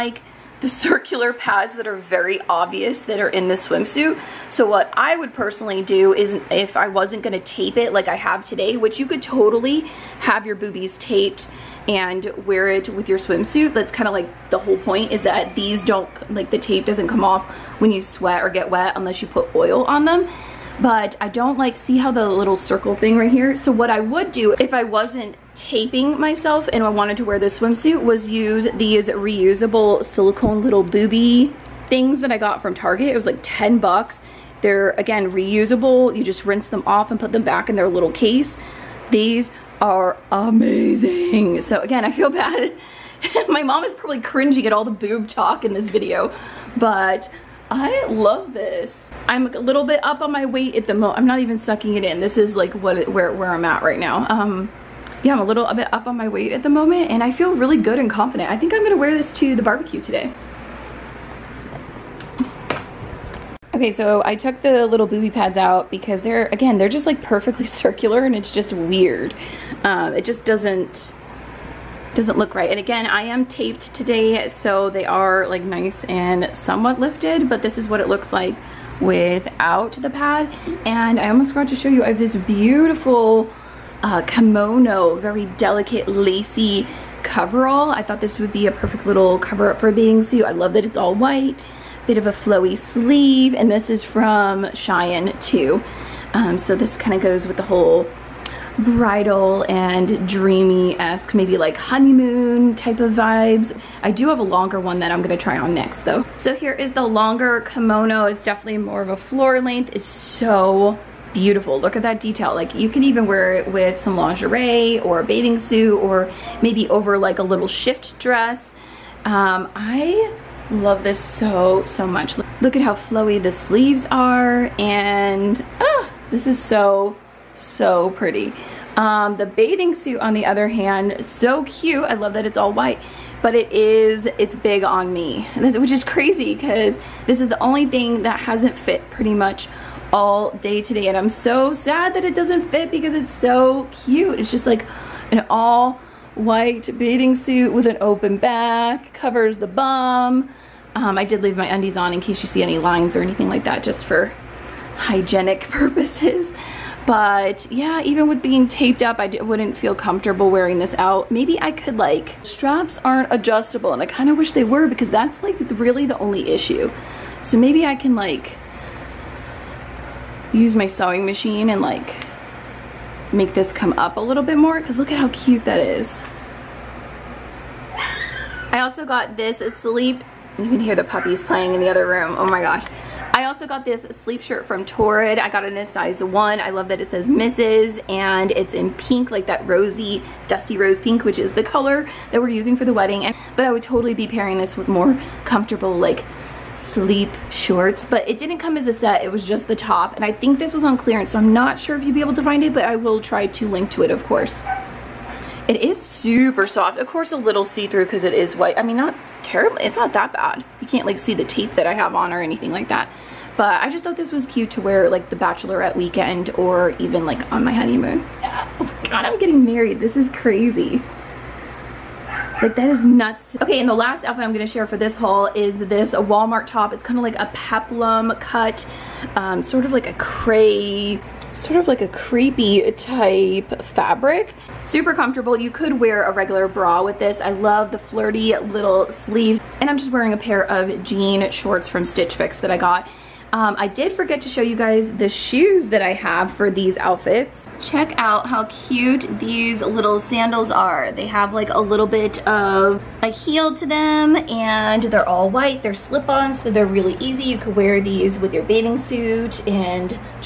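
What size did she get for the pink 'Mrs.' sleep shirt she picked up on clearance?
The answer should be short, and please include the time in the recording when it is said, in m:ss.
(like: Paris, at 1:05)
size 1, at 3:05.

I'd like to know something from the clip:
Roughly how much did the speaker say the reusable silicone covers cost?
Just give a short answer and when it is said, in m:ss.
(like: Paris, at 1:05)
10 bucks, at 0:33.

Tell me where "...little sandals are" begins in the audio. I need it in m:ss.
4:09.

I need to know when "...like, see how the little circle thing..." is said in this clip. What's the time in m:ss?
0:21.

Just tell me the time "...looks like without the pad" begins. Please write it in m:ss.
1:18.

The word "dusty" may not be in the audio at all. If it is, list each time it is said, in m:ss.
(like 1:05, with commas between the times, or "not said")
3:10.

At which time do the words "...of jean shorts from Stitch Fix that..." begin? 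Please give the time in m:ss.
4:00.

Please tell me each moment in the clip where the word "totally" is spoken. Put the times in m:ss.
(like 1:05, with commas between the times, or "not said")
0:09, 3:13.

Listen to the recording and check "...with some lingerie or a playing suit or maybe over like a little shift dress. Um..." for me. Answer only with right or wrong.
wrong.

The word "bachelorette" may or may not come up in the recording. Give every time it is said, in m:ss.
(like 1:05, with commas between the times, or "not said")
3:35.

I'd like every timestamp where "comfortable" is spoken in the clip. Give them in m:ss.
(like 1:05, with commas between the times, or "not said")
2:39, 3:15, 3:55.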